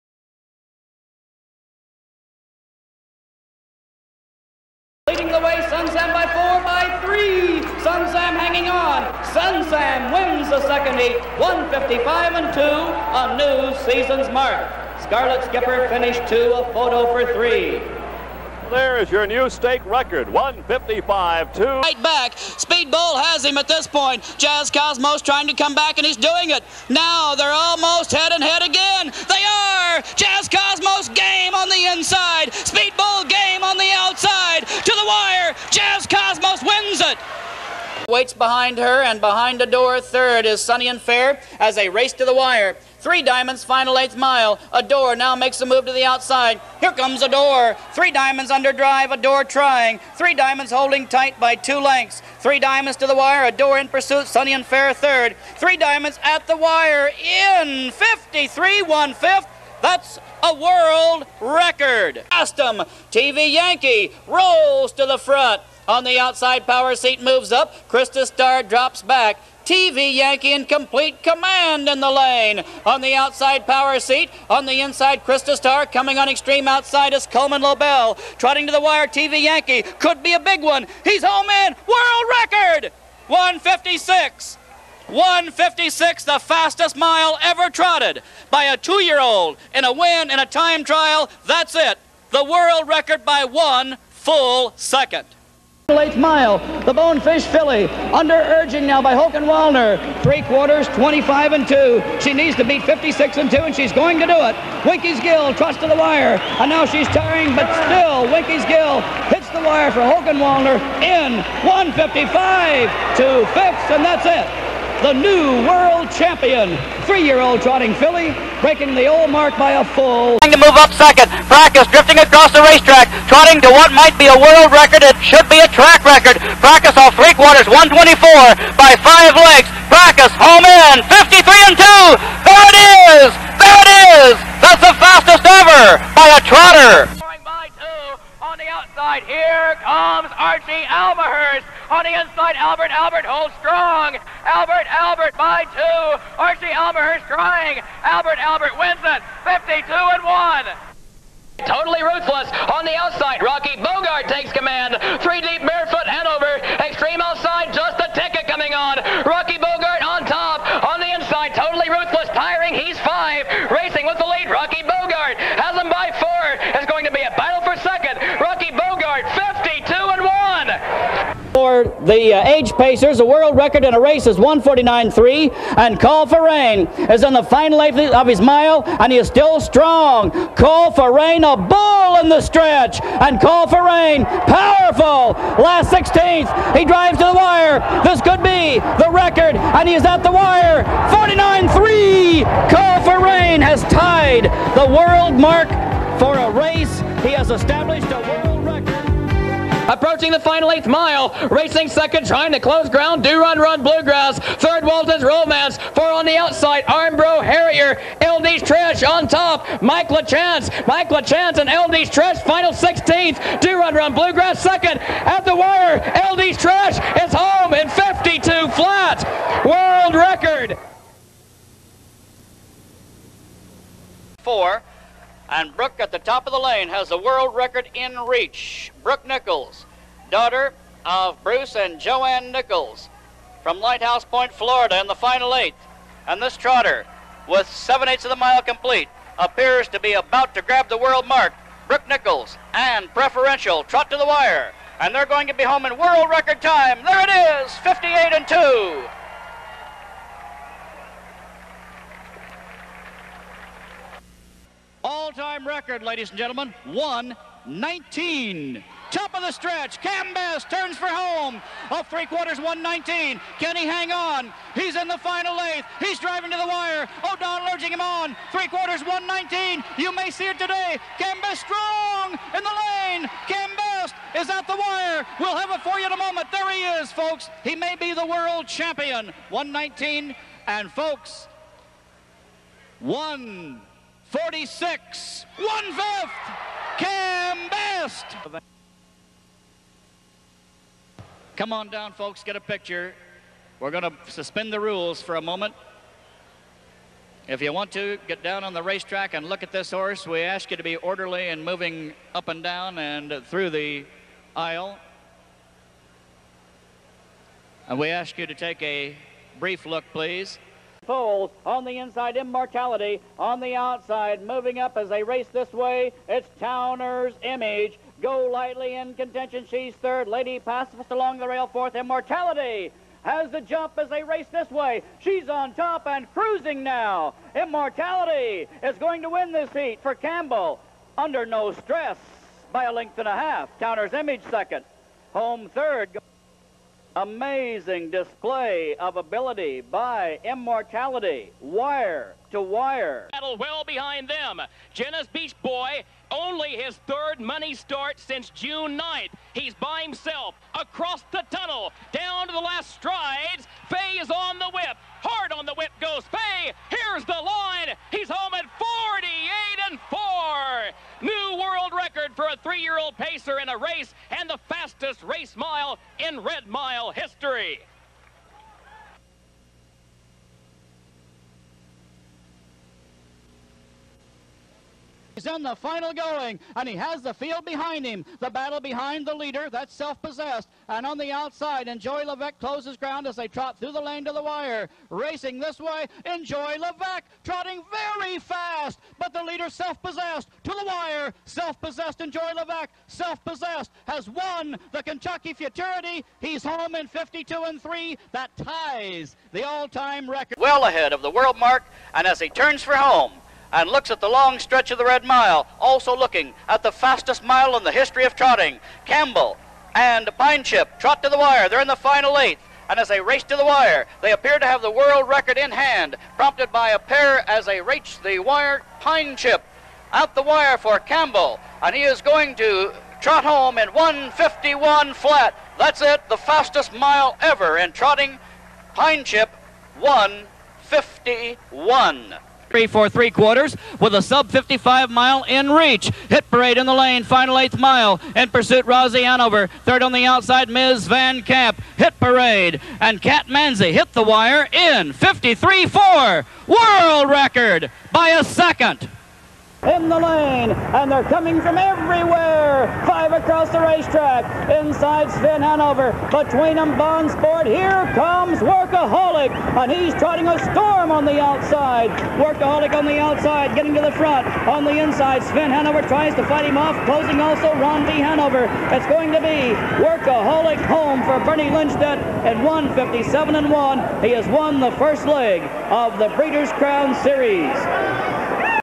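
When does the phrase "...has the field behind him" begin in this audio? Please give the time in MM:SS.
06:16.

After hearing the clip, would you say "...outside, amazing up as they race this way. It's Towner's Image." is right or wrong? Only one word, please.
wrong.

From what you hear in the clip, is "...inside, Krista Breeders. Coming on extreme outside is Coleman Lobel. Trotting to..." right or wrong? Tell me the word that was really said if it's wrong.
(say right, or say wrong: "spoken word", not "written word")
wrong: "Star", not "Breeders".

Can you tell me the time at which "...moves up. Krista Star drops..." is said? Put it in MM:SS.
01:07.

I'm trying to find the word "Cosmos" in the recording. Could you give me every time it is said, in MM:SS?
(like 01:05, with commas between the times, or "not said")
00:24, 00:30.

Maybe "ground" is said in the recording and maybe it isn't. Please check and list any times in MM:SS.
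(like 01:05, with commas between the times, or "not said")
03:22, 06:22.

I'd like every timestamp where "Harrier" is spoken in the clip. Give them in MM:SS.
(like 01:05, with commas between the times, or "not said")
03:27.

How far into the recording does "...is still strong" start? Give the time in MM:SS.
02:59.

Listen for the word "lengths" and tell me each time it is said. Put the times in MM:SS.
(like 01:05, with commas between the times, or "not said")
00:51, 05:32.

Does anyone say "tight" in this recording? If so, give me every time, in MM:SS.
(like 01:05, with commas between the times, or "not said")
00:51.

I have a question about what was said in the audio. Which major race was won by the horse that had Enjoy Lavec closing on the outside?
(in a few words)
Kentucky Futurity.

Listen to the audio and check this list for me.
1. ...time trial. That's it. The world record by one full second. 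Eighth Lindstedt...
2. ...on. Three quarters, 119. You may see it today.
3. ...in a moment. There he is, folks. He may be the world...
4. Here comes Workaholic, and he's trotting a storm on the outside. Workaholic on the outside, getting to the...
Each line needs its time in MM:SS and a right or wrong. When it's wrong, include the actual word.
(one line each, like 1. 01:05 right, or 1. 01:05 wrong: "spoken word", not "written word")
1. 01:30 wrong: "Mile", not "Lindstedt"
2. 04:28 right
3. 04:36 right
4. 07:37 right.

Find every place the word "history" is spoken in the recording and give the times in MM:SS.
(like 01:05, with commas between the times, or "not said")
06:07, 06:47.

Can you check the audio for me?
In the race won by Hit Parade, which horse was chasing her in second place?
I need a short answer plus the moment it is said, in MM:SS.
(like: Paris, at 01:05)
Rosie Hanover, at 07:18.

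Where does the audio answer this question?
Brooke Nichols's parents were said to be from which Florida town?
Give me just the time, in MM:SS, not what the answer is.
03:53.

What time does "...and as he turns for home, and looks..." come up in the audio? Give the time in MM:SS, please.
06:42.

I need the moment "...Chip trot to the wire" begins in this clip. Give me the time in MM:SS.
06:50.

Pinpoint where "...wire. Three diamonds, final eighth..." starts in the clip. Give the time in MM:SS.
00:42.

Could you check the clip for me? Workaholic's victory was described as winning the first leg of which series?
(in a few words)
Breeders' Crown Series.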